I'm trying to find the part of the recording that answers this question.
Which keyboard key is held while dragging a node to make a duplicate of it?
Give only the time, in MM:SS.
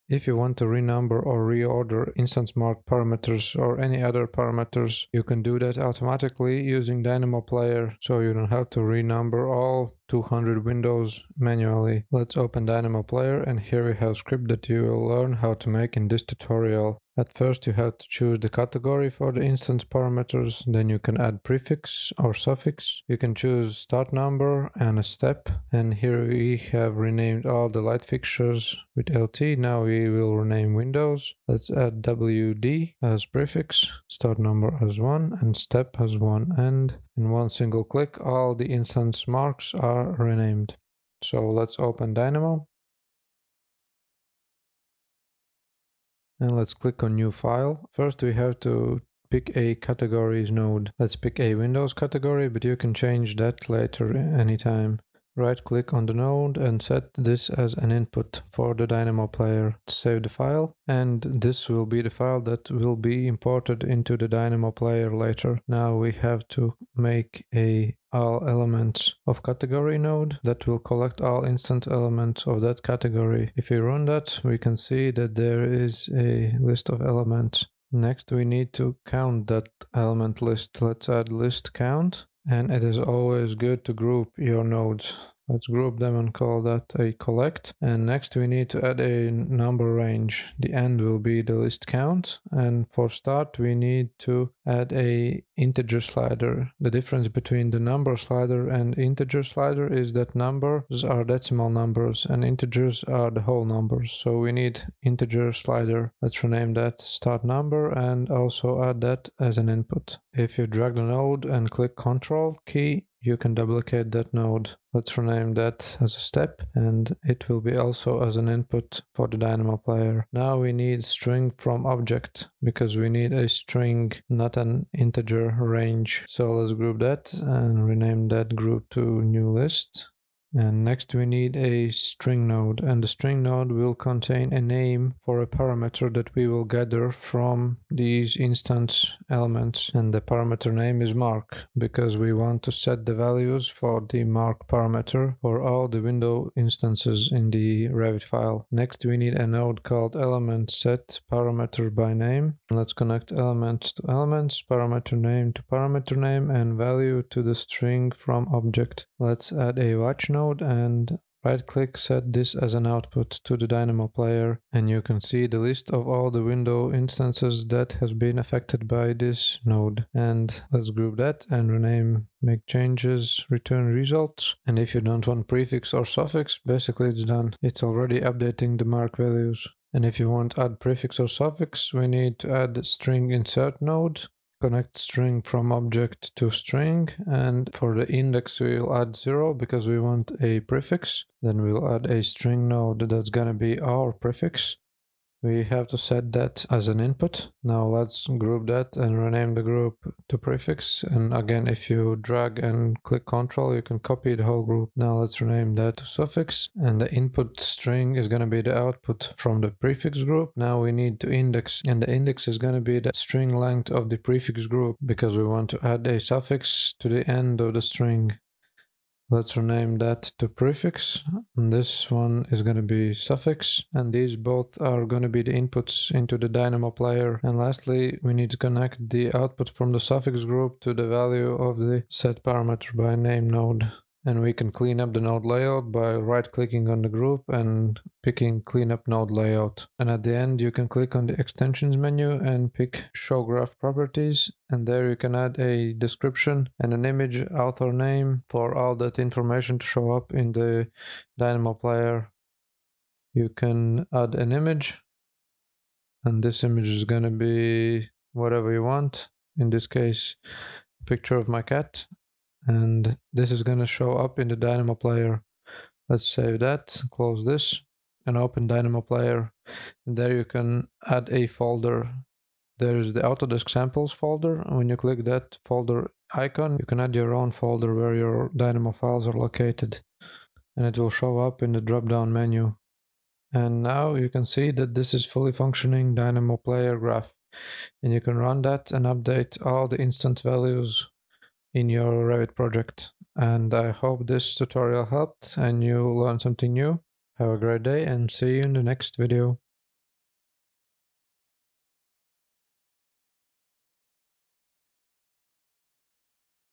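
01:51.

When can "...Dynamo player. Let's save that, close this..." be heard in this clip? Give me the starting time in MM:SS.
04:24.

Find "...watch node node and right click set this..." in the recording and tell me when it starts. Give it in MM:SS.
02:39.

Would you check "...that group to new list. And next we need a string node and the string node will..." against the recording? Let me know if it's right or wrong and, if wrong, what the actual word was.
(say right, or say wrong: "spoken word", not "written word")
right.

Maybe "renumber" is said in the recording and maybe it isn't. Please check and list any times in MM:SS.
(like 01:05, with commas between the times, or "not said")
00:00, 00:08.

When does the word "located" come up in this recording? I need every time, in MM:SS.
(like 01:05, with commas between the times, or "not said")
04:39.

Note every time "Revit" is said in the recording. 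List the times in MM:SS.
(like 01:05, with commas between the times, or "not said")
02:27, 04:52.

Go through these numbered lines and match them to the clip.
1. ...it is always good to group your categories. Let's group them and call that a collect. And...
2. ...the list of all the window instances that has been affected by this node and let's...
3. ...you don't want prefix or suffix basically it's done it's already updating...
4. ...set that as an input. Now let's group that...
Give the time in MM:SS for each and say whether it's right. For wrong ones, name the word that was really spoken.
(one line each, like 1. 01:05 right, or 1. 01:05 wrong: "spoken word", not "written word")
1. 01:22 wrong: "nodes", not "categories"
2. 02:45 right
3. 02:54 right
4. 03:15 right.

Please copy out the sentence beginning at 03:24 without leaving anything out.
Now let's rename that to suffix.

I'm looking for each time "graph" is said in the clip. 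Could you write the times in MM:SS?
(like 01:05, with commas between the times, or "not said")
04:03, 04:46.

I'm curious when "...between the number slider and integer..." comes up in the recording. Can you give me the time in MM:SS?
01:37.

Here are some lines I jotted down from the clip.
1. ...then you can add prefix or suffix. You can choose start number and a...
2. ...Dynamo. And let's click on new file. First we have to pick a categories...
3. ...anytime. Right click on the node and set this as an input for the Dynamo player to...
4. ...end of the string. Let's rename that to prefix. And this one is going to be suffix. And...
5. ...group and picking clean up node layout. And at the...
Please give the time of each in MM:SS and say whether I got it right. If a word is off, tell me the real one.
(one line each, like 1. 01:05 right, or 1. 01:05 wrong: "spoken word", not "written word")
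1. 00:20 right
2. 00:42 right
3. 00:54 right
4. 03:37 right
5. 03:57 right.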